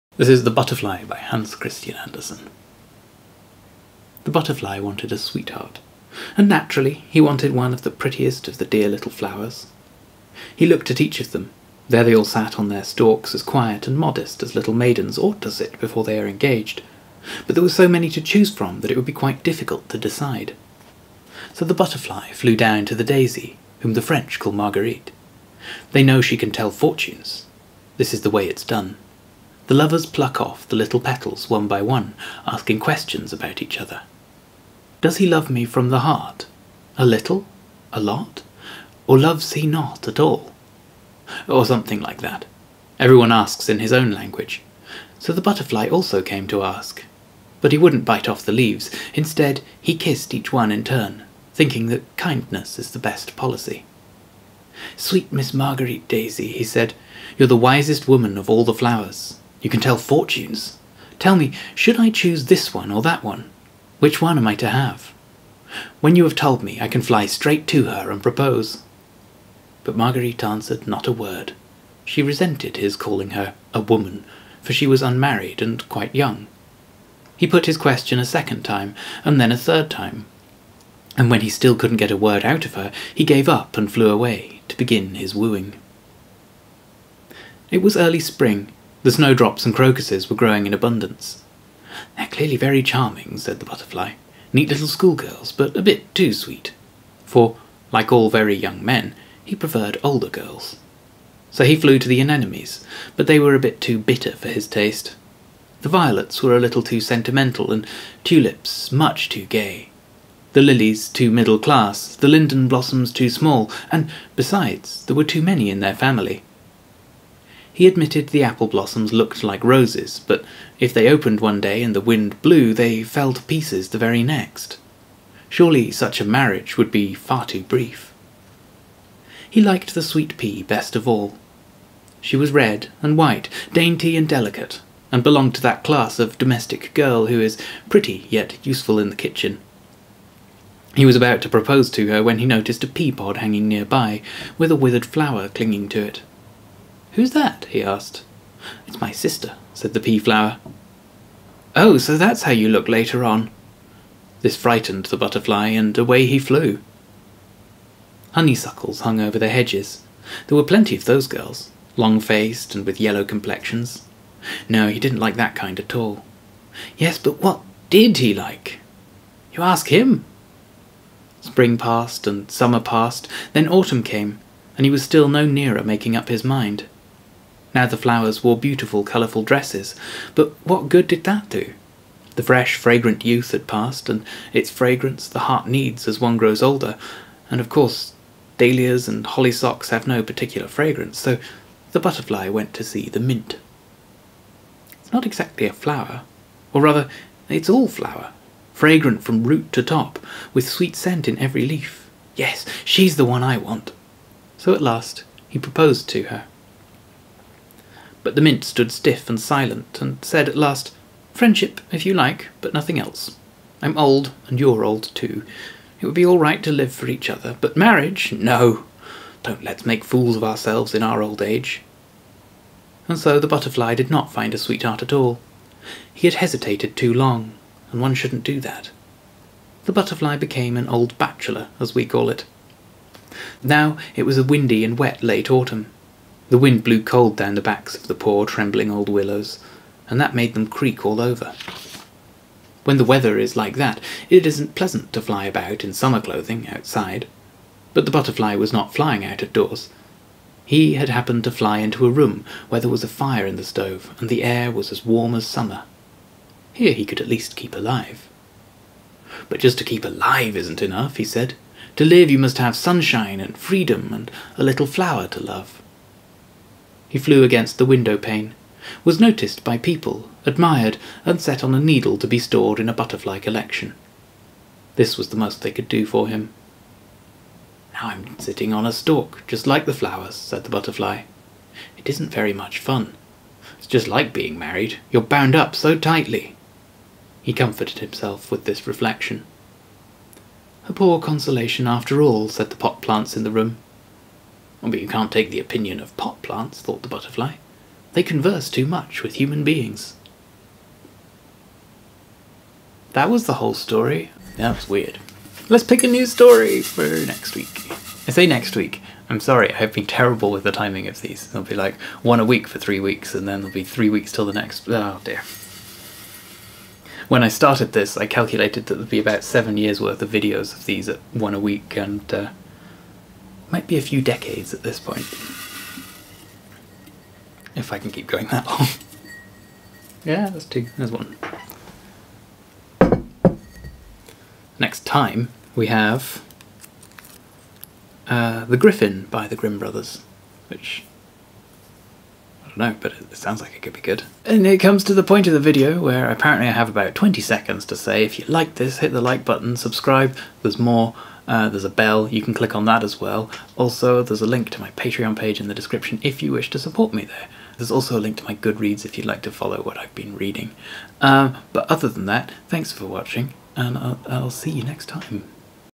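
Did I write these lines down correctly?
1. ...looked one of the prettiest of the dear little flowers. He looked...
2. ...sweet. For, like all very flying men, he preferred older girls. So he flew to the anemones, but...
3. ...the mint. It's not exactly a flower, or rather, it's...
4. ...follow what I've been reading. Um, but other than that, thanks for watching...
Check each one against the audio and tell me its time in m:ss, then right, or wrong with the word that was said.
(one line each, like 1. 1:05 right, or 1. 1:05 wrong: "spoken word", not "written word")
1. 0:07 wrong: "wanted", not "looked"
2. 1:36 wrong: "young", not "flying"
3. 3:13 right
4. 5:59 right.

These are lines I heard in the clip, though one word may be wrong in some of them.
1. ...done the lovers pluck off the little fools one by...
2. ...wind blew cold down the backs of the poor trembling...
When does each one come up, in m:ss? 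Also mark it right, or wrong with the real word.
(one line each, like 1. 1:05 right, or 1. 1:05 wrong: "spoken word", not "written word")
1. 0:28 wrong: "petals", not "fools"
2. 3:56 right.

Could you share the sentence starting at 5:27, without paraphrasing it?
If I can keep going that long.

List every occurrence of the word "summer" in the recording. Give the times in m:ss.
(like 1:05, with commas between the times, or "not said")
2:52, 4:05, 4:15.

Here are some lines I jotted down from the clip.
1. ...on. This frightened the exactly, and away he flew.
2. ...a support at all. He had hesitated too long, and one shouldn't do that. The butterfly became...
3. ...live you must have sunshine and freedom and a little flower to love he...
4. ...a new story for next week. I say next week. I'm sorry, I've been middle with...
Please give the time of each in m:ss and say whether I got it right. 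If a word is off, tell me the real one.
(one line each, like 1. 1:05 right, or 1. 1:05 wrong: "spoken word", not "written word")
1. 2:33 wrong: "butterfly", not "exactly"
2. 3:44 wrong: "sweetheart", not "support"
3. 4:22 right
4. 5:06 wrong: "terrible", not "middle".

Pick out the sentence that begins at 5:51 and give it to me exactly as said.
Uh, there's a bell, you can click on that as well.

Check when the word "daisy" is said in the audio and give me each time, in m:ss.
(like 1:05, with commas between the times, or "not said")
0:23, 0:56.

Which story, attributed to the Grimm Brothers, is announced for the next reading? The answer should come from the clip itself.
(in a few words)
The Griffin.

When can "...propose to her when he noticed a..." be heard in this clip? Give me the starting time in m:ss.
2:21.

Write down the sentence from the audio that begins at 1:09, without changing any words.
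But Marguerite answered not a word.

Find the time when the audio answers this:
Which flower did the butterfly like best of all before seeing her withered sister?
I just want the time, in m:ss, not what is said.
2:10.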